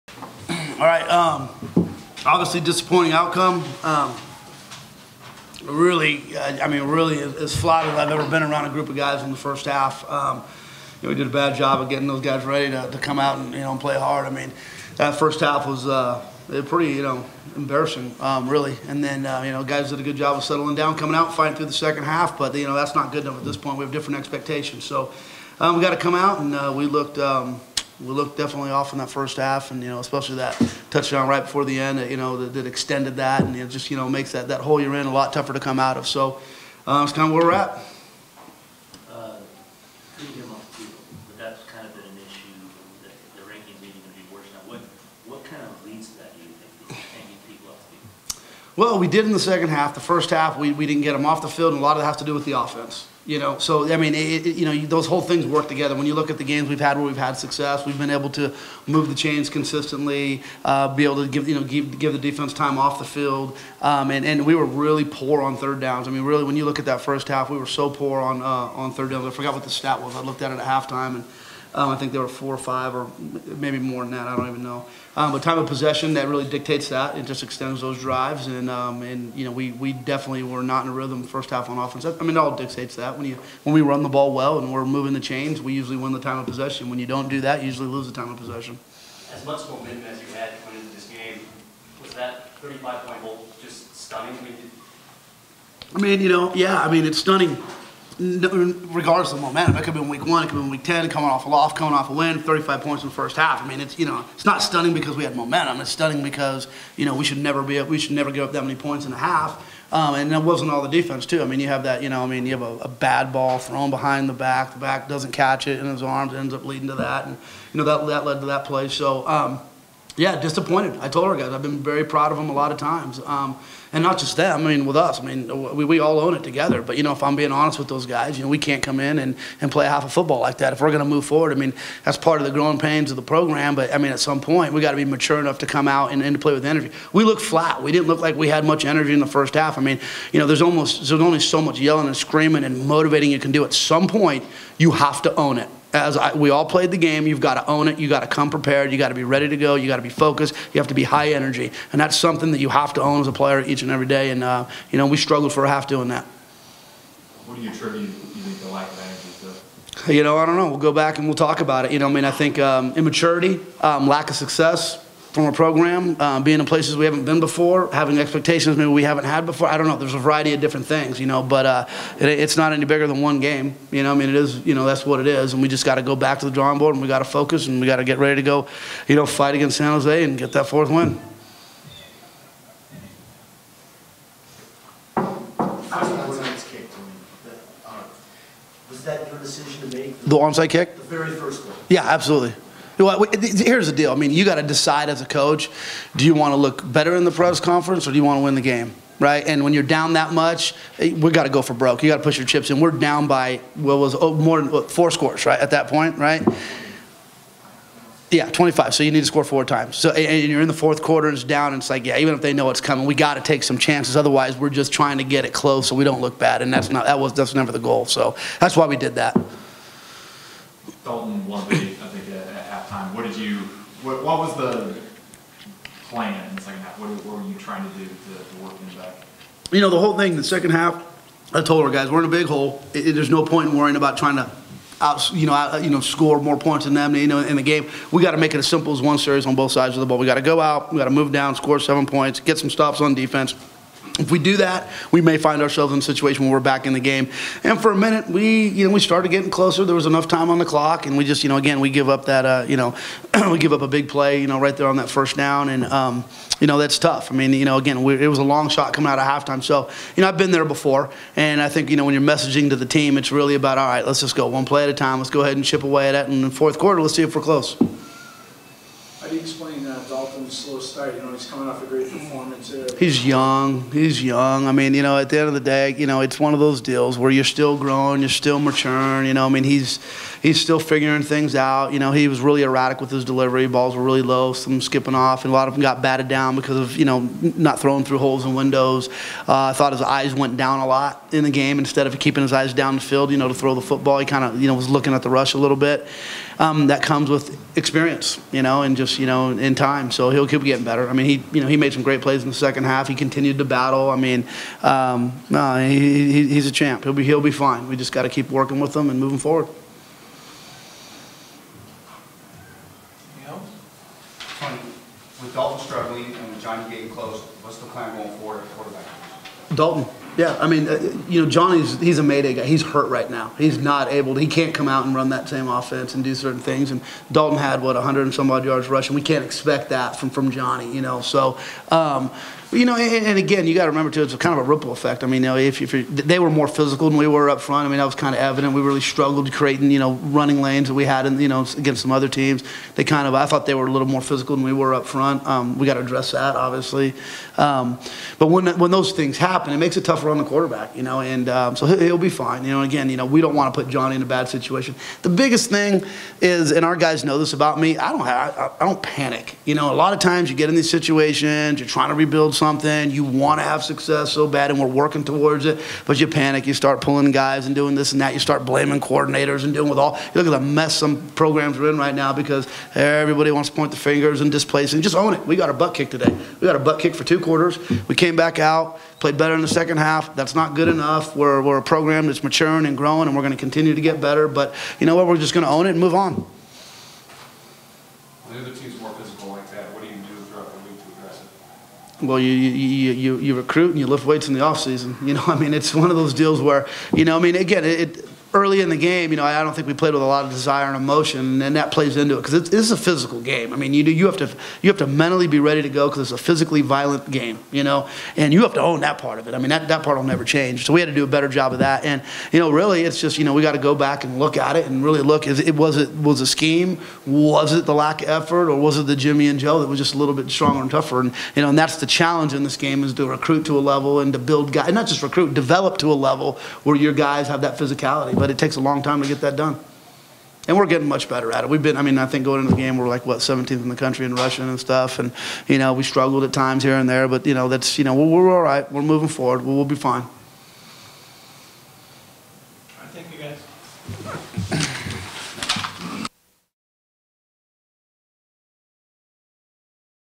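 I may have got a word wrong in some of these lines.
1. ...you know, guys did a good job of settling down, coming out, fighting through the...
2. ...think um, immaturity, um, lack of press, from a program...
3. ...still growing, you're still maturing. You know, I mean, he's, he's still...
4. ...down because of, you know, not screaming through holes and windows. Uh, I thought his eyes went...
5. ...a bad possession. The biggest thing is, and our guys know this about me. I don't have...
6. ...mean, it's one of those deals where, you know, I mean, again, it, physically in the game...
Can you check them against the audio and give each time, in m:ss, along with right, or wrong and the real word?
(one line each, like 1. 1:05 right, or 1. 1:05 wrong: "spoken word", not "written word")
1. 0:19 right
2. 2:42 wrong: "success", not "press"
3. 4:37 right
4. 4:46 wrong: "throwing", not "screaming"
5. 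5:54 wrong: "situation", not "possession"
6. 6:35 wrong: "early", not "physically".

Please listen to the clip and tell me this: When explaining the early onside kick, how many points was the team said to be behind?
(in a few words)
25.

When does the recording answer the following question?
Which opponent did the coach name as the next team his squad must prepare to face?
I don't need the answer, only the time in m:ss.
2:59.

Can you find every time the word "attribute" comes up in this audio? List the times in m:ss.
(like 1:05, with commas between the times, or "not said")
2:37.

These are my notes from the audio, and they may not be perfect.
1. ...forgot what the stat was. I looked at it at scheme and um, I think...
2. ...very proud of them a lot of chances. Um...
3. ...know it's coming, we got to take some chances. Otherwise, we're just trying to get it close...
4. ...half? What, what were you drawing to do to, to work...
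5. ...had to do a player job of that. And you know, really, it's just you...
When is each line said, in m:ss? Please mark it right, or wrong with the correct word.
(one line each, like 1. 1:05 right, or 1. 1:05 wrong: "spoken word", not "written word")
1. 1:09 wrong: "halftime", not "scheme"
2. 2:01 wrong: "times", not "chances"
3. 3:32 right
4. 3:46 wrong: "trying", not "drawing"
5. 6:50 wrong: "better", not "player".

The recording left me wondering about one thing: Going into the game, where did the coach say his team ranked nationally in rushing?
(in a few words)
17th.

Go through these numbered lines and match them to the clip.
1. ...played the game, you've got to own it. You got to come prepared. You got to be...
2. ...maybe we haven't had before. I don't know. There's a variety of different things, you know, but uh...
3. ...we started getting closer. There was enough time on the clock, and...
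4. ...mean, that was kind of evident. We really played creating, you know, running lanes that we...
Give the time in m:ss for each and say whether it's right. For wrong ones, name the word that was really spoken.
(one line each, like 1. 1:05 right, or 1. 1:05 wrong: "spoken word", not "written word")
1. 2:26 right
2. 2:48 right
3. 4:08 right
4. 5:37 wrong: "struggled", not "played".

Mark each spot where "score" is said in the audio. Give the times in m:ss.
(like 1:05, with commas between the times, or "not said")
3:25, 3:29, 3:55, 4:01.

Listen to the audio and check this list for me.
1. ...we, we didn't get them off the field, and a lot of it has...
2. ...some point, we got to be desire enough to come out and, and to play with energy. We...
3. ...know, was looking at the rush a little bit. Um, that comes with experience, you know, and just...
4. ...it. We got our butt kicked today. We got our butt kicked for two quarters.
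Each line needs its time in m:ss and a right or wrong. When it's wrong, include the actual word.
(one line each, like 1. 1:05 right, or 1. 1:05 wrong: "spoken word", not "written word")
1. 0:50 right
2. 2:14 wrong: "mature", not "desire"
3. 4:54 right
4. 6:15 right.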